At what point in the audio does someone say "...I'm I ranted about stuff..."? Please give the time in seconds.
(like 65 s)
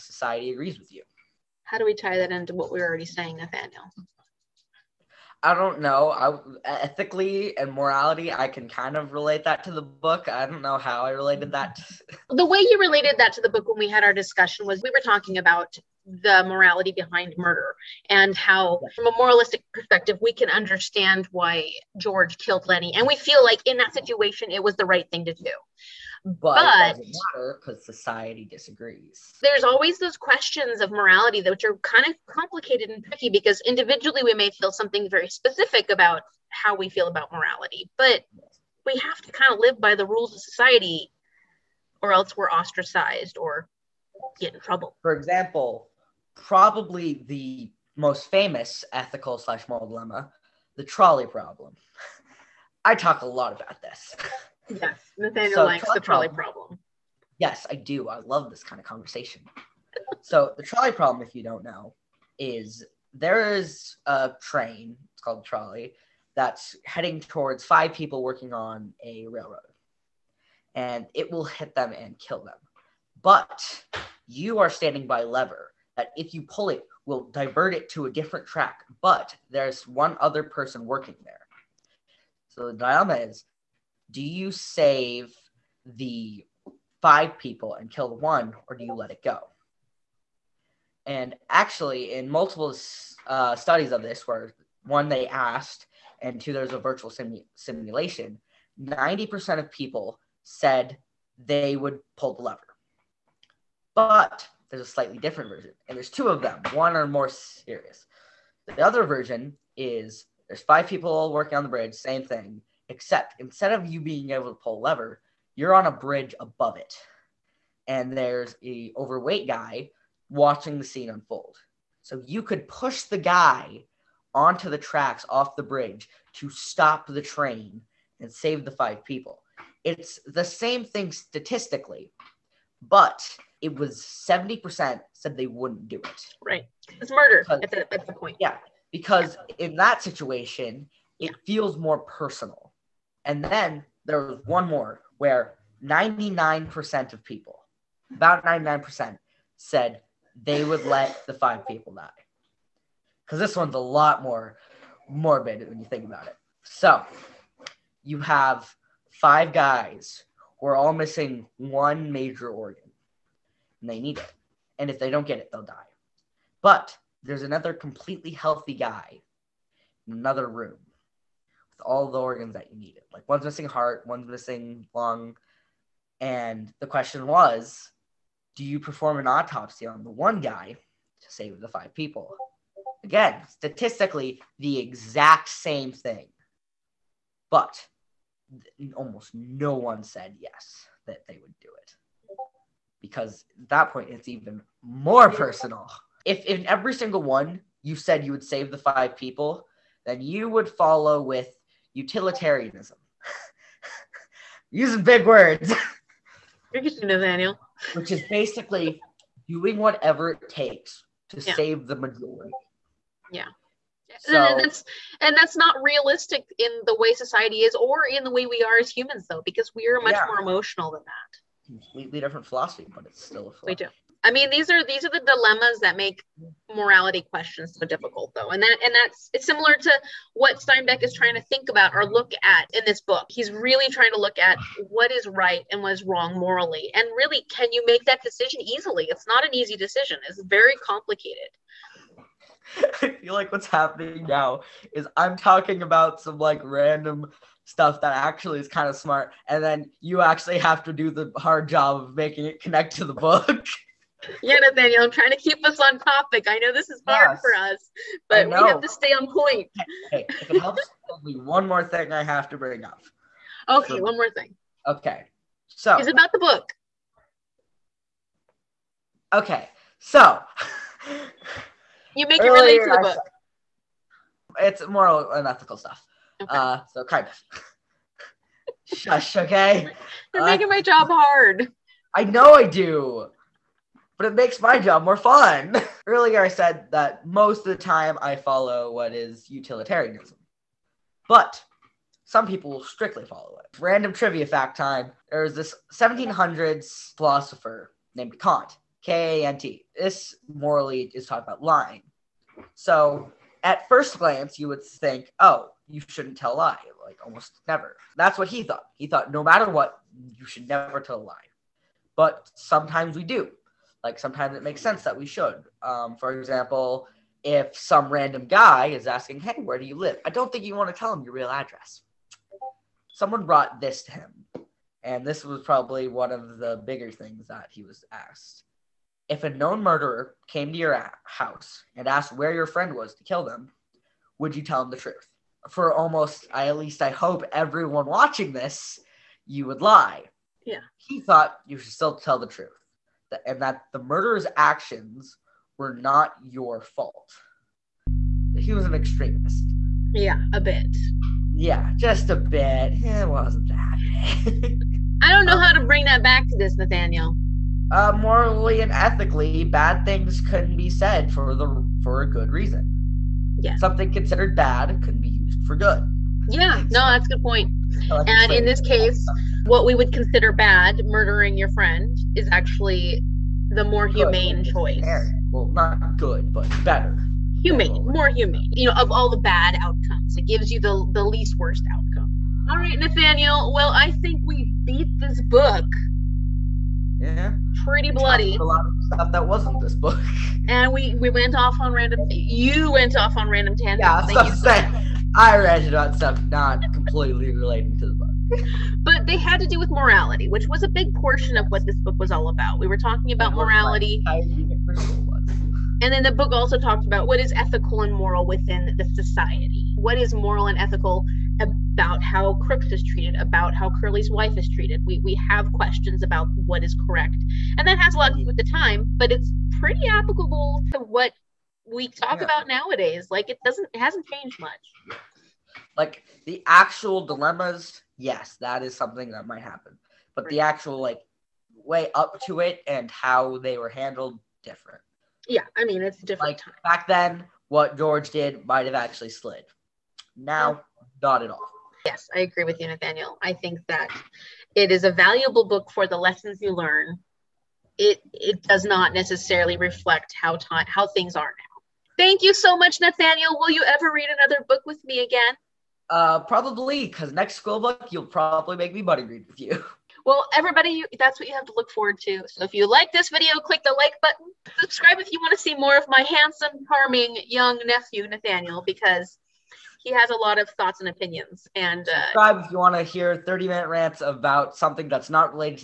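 395 s.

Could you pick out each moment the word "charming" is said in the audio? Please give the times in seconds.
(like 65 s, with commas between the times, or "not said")
466 s.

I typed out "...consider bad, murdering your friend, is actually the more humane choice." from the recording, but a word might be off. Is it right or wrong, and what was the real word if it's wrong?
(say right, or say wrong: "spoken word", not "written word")
right.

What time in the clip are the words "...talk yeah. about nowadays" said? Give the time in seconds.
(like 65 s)
422 s.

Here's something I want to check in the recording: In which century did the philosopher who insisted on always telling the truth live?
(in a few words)
1700s.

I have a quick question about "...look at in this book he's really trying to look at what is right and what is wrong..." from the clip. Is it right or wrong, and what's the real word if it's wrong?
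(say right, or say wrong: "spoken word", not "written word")
right.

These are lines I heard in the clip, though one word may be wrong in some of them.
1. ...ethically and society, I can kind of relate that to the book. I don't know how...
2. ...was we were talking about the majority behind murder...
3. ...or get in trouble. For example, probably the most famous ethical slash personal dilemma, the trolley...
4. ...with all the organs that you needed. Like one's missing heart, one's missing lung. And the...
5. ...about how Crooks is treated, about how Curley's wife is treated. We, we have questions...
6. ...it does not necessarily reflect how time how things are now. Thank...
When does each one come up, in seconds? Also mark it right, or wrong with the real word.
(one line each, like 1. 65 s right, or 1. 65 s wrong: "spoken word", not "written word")
1. 6 s wrong: "morality", not "society"
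2. 14 s wrong: "morality", not "majority"
3. 43 s wrong: "moral", not "personal"
4. 171 s right
5. 411 s right
6. 448 s right.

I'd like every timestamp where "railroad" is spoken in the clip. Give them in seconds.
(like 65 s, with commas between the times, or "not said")
69 s.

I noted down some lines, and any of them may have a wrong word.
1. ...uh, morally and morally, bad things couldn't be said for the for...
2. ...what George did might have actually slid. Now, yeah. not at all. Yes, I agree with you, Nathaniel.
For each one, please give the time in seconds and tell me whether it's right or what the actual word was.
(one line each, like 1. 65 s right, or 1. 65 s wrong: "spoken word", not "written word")
1. 357 s wrong: "ethically", not "morally"
2. 437 s right.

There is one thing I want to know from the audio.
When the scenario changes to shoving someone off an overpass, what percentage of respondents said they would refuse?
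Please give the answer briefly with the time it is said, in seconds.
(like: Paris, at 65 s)
70%, at 134 s.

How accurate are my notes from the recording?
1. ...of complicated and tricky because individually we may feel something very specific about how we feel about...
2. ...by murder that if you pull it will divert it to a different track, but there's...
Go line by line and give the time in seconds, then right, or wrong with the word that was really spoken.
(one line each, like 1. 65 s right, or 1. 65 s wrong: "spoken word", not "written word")
1. 32 s right
2. 75 s wrong: "lever", not "murder".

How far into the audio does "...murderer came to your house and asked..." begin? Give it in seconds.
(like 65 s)
329 s.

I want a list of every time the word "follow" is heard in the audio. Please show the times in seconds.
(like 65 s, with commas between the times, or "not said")
200 s, 288 s, 293 s.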